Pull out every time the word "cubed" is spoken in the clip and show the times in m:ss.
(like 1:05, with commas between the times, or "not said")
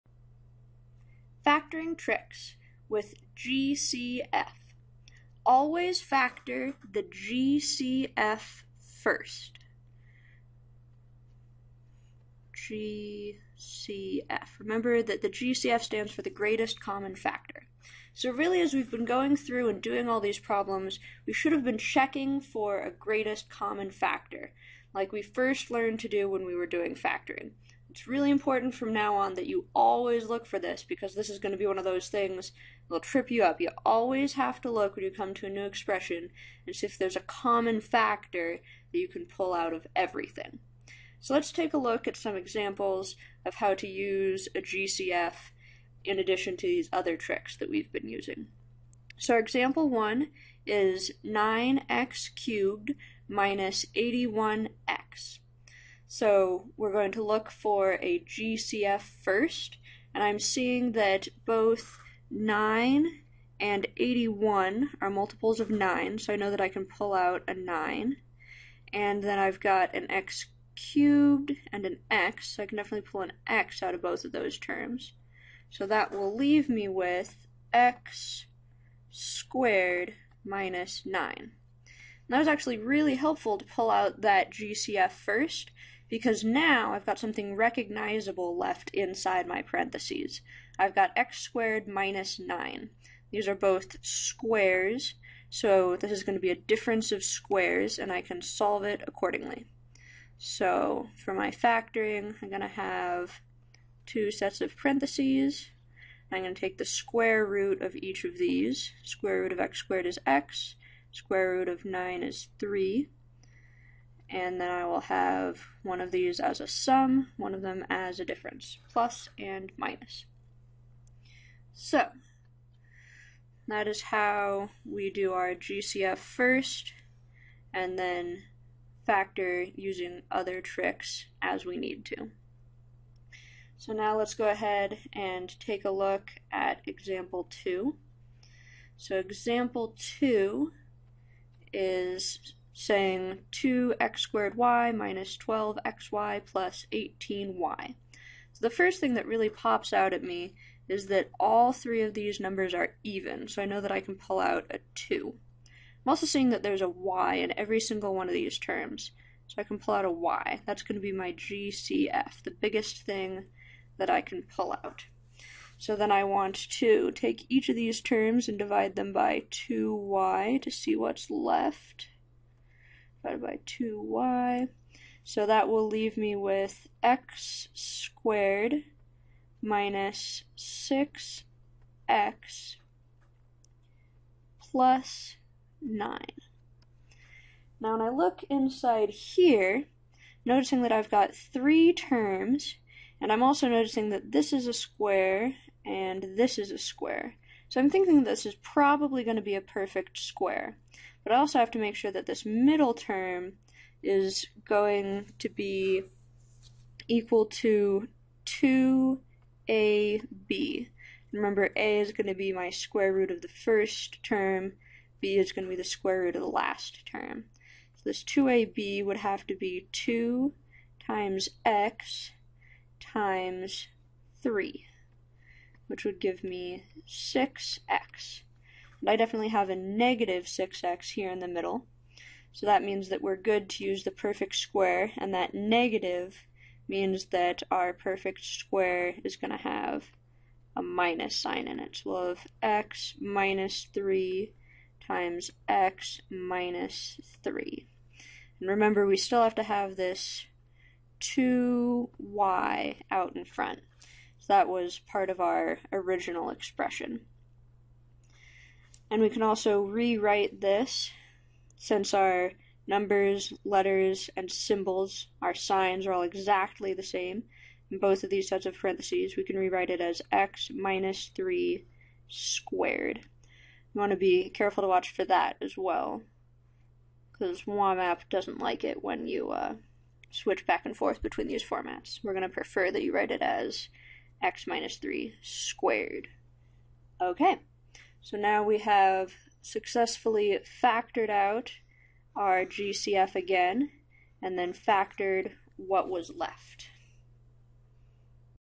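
0:52, 1:10.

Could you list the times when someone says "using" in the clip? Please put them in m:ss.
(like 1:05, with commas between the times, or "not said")
0:48, 2:09.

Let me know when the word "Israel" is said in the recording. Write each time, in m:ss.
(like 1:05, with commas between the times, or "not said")
not said.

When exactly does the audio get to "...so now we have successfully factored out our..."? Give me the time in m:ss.
4:48.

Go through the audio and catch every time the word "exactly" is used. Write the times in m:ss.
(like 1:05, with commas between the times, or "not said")
4:26.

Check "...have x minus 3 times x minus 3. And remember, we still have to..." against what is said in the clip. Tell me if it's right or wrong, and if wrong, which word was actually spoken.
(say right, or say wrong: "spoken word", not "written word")
right.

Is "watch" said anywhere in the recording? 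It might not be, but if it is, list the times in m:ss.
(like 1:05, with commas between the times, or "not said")
4:34.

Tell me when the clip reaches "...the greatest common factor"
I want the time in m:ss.
0:16.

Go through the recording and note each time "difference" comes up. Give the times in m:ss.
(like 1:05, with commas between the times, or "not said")
1:36, 1:58.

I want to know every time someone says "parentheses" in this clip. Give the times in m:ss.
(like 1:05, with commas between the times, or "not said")
1:29, 1:44, 4:28.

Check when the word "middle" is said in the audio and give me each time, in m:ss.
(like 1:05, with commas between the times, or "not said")
3:22, 3:51.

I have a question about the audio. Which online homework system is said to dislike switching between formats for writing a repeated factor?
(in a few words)
WAMAP.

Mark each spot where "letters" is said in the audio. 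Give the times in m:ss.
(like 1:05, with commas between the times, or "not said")
4:23.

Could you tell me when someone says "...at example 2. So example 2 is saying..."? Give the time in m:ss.
2:16.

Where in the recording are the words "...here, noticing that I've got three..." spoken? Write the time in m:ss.
3:09.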